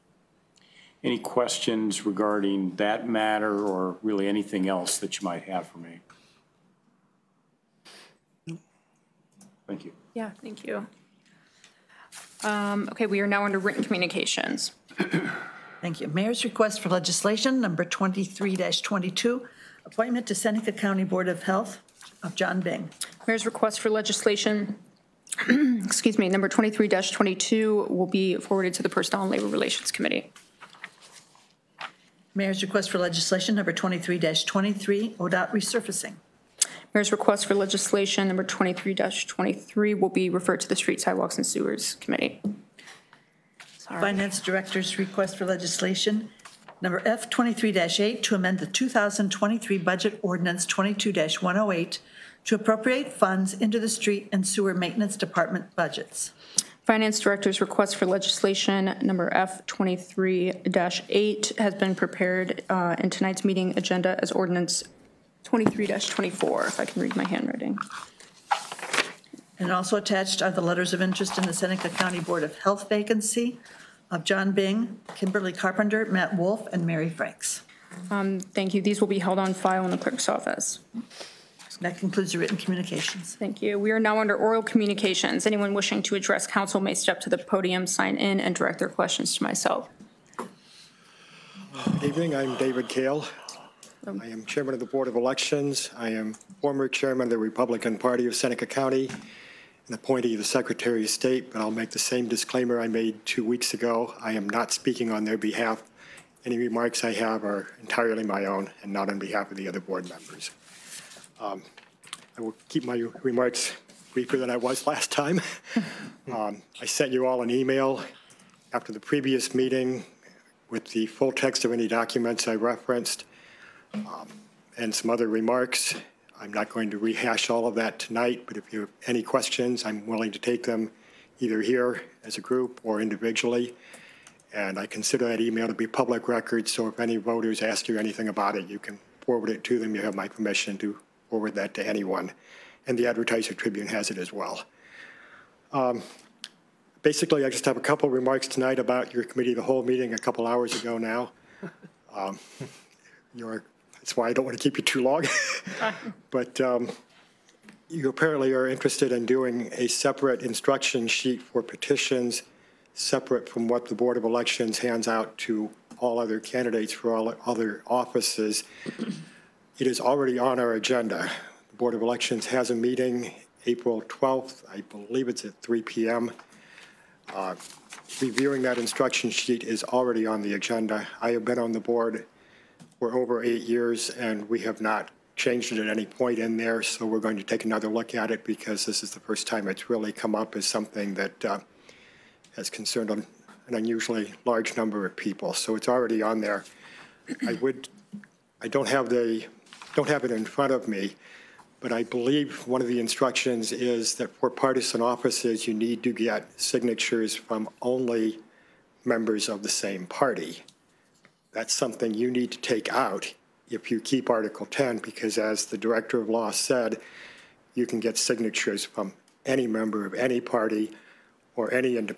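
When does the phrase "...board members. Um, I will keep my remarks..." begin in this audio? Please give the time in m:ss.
1:49.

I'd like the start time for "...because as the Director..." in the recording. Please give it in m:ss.
3:34.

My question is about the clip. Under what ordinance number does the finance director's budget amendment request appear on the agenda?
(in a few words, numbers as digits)
23-24.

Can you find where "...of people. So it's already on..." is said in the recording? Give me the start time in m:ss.
3:15.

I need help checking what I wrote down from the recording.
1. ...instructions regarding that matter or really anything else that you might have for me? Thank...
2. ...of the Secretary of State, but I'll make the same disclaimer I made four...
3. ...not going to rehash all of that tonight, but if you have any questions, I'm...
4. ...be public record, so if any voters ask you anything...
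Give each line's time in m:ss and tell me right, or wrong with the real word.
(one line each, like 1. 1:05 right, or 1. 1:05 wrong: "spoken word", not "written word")
1. 0:01 wrong: "questions", not "instructions"
2. 1:40 wrong: "two", not "four"
3. 2:06 right
4. 2:15 right.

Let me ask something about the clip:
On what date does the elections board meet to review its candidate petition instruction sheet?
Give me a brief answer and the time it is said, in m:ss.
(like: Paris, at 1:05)
April 12, at 2:53.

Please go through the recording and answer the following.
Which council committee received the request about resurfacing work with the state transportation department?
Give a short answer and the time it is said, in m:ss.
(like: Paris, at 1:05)
Street Sidewalks and Sewers Committee, at 0:40.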